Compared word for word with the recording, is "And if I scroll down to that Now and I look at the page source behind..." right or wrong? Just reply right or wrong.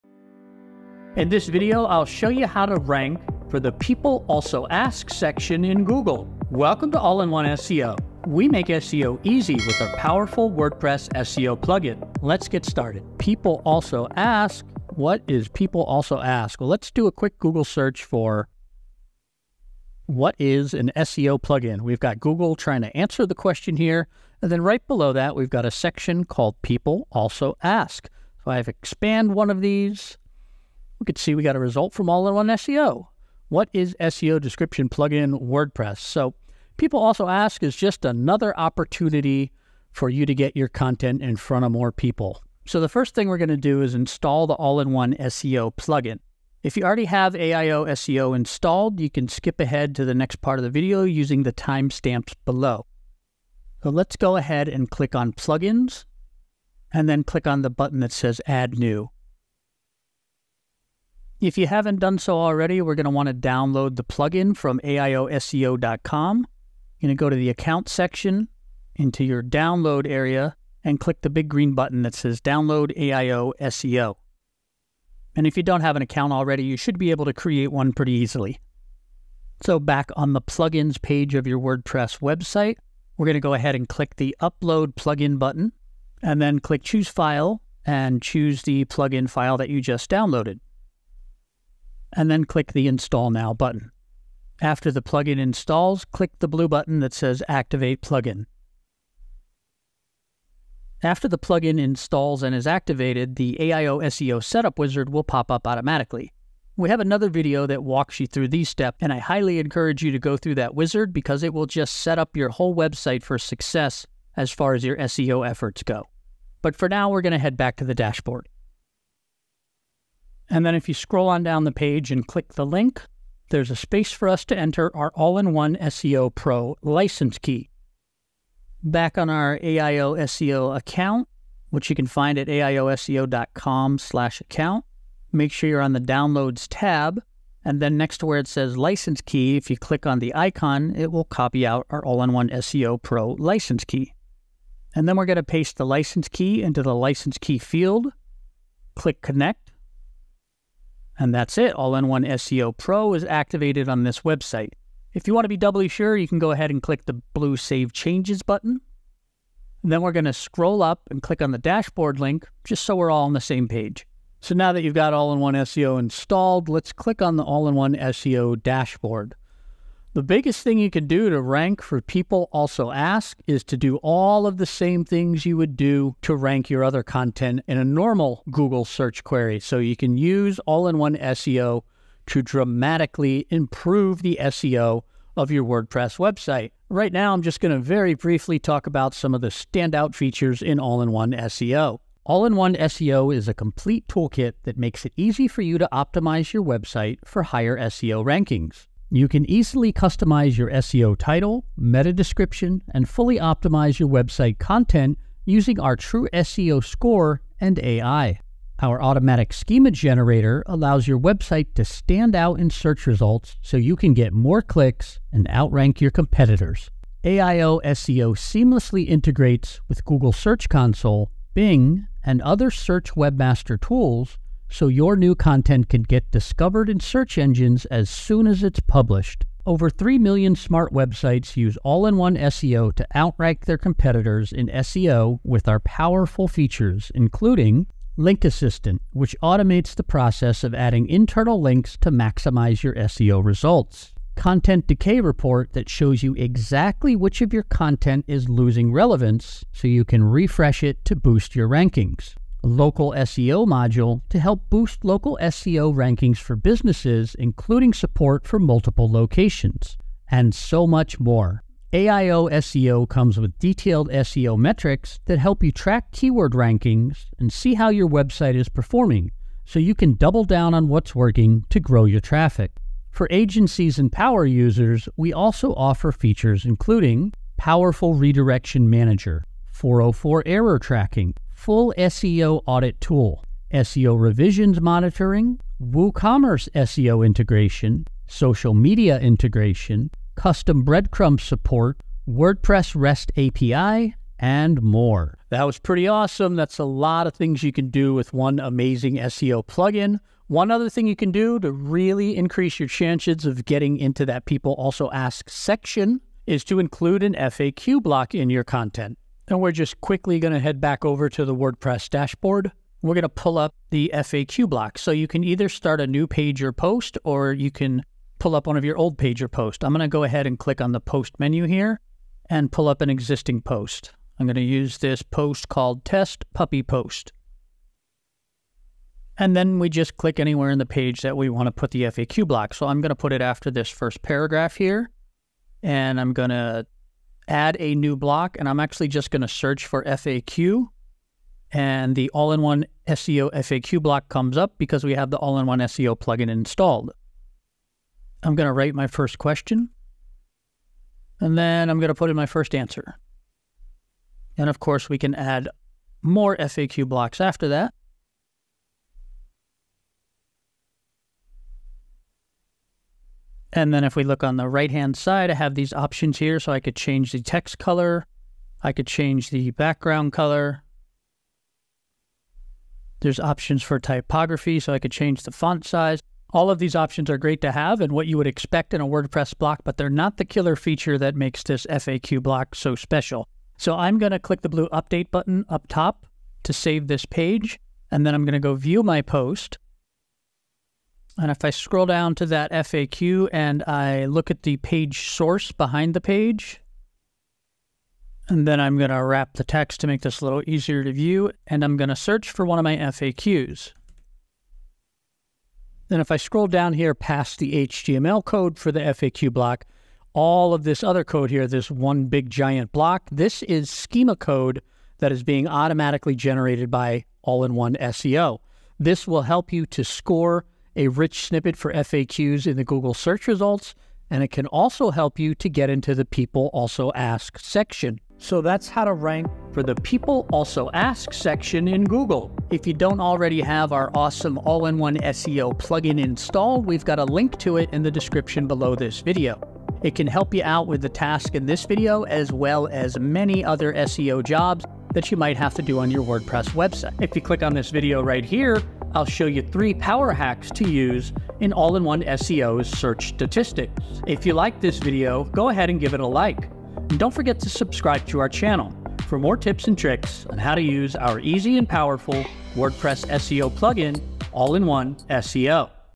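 wrong.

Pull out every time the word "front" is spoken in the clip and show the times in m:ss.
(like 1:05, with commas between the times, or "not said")
0:41.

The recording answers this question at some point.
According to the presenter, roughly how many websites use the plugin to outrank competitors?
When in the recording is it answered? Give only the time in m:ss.
3:49.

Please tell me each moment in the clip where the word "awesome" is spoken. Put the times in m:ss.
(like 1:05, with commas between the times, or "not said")
4:56, 7:14.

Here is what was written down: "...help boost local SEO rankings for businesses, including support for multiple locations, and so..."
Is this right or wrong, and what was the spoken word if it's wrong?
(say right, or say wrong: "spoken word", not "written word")
right.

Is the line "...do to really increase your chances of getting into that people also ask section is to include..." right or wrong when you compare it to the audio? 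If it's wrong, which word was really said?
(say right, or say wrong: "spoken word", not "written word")
right.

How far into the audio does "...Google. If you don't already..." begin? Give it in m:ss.
7:12.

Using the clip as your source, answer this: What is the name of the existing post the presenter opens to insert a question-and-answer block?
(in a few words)
test puppy post.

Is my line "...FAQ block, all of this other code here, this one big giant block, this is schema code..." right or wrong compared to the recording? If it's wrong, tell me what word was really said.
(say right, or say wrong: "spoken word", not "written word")
right.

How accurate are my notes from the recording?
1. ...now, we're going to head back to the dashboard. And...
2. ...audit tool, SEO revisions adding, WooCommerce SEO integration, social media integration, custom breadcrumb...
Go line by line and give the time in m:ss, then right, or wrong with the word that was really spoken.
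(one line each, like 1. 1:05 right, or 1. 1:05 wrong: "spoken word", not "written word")
1. 1:56 right
2. 4:42 wrong: "monitoring", not "adding".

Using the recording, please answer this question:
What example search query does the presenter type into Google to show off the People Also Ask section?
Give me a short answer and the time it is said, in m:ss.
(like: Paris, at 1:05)
what is an SEO plugin?, at 0:20.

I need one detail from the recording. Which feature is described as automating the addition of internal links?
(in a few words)
Link Assistant.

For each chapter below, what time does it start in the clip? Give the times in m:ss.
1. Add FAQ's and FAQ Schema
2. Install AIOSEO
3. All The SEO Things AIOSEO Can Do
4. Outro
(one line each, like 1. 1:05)
1. 4:55
2. 0:42
3. 2:43
4. 7:08.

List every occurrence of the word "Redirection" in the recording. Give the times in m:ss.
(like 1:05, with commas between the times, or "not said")
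4:38.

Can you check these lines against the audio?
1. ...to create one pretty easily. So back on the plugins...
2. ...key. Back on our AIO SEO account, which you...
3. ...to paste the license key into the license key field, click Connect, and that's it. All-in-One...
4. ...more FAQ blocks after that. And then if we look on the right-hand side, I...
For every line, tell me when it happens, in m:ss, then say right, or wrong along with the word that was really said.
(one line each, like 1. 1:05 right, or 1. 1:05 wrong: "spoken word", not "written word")
1. 1:17 right
2. 2:07 right
3. 2:25 right
4. 5:56 right.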